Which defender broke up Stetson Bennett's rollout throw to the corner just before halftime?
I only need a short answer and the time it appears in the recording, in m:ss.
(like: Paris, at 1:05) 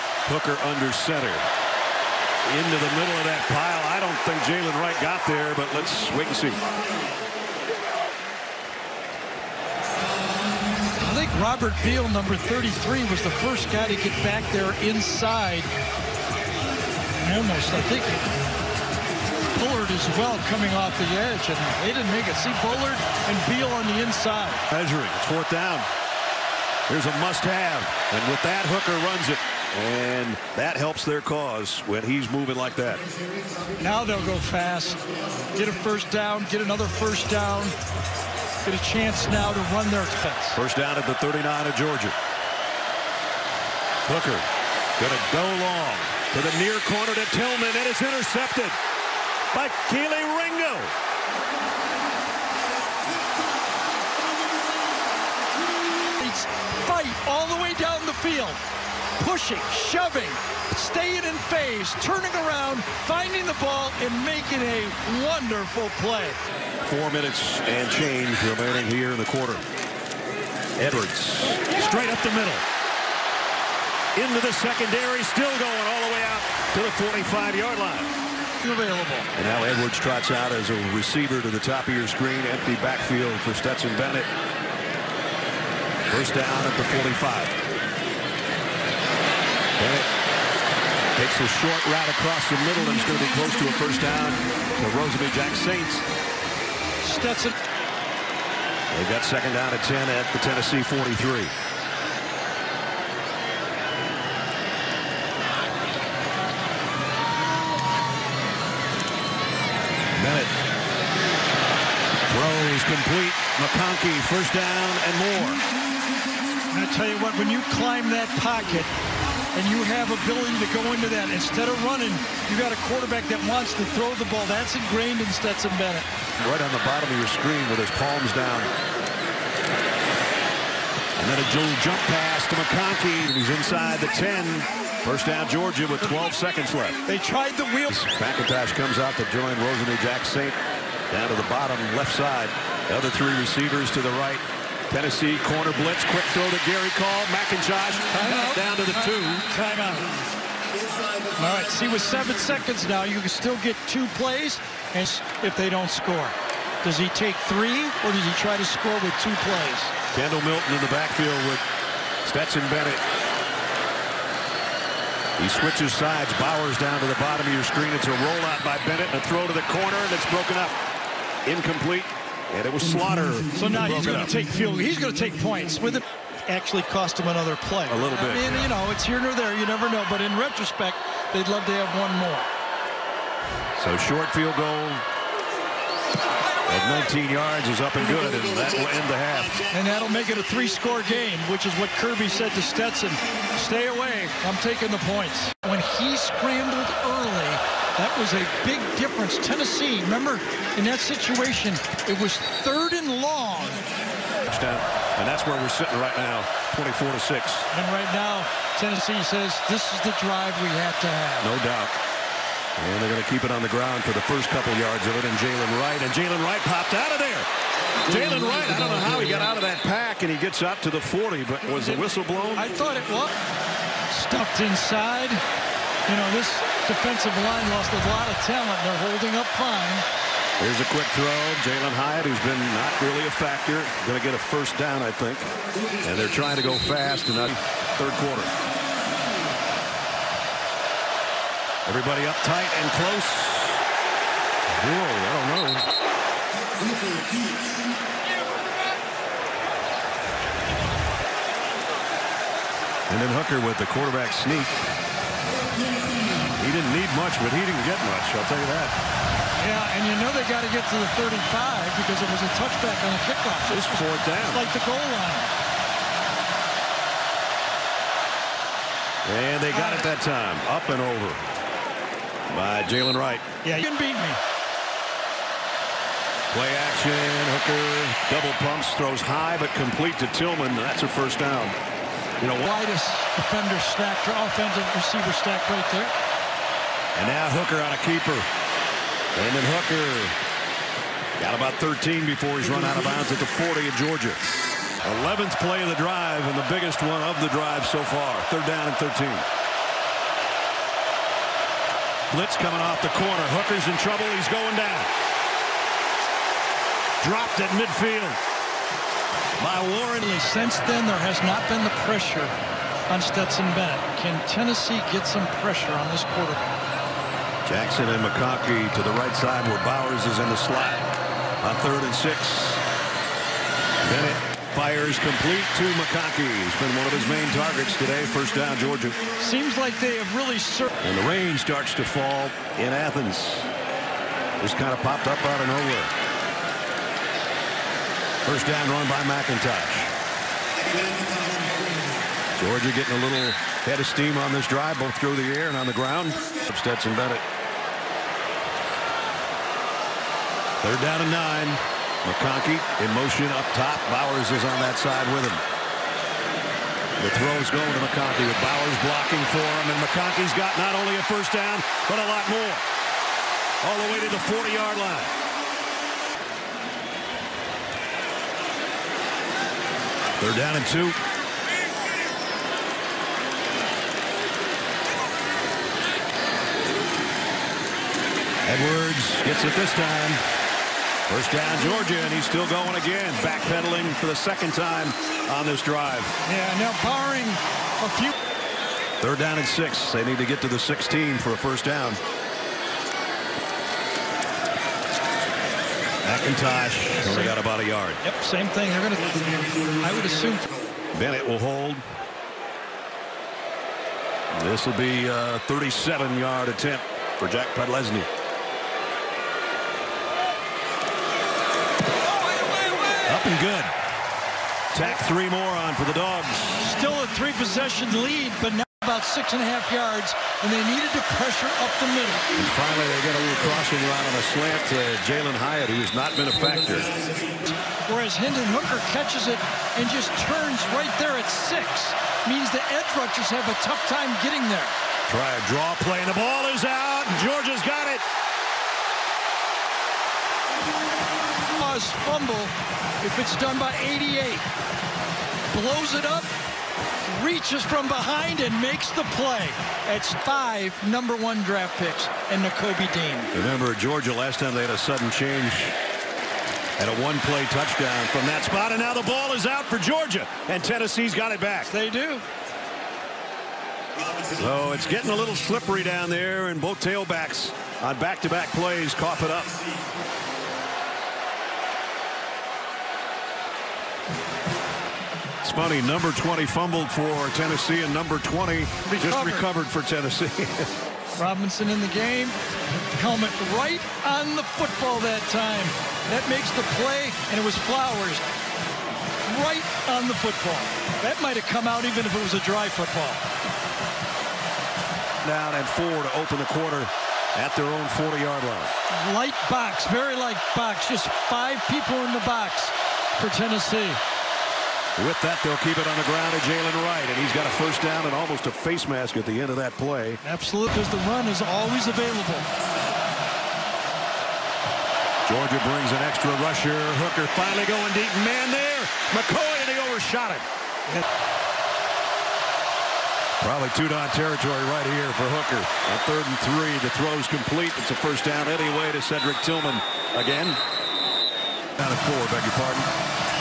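Slaughter, at 2:52.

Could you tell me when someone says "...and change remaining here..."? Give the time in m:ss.
1:07.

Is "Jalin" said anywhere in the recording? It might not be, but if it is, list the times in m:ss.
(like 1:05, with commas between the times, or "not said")
3:51, 7:05.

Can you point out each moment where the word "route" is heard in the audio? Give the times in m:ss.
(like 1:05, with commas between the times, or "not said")
1:31, 7:03.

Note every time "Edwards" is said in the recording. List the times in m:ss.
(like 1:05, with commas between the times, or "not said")
1:10, 1:19, 6:18.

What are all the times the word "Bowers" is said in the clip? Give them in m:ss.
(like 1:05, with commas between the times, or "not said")
2:46, 5:19, 5:54, 5:58.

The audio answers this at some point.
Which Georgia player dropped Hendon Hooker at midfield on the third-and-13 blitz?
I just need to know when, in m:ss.
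5:09.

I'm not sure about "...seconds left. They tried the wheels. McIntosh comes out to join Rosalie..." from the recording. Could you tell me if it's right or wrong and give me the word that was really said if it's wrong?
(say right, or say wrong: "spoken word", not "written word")
right.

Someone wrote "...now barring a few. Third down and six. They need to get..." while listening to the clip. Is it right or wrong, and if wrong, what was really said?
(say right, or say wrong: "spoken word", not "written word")
right.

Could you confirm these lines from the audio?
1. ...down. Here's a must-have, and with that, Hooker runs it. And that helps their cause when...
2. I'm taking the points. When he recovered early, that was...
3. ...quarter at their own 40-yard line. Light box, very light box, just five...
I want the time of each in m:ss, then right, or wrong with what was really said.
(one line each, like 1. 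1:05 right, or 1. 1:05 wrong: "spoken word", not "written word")
1. 0:25 right
2. 3:14 wrong: "scrambled", not "recovered"
3. 8:16 right.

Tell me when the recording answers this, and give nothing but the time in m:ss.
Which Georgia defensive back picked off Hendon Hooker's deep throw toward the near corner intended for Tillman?
0:49.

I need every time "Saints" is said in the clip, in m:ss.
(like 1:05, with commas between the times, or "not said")
1:35, 2:20.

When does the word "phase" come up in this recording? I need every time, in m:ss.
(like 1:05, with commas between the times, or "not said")
1:01.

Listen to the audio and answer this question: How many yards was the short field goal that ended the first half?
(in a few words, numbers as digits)
19.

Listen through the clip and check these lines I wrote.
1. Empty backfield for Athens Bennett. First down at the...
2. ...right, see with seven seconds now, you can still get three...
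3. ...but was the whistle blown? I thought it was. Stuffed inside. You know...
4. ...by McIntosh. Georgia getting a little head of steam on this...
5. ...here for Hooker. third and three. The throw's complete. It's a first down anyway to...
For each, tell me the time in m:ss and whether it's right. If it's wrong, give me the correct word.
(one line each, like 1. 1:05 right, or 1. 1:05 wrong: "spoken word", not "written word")
1. 1:22 wrong: "Stetson", not "Athens"
2. 2:31 wrong: "two", not "three"
3. 3:41 right
4. 5:39 right
5. 8:45 right.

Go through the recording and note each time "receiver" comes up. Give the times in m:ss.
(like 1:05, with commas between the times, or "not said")
1:20, 2:23, 4:44.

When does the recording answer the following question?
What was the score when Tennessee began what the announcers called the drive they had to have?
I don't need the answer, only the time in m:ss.
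3:26.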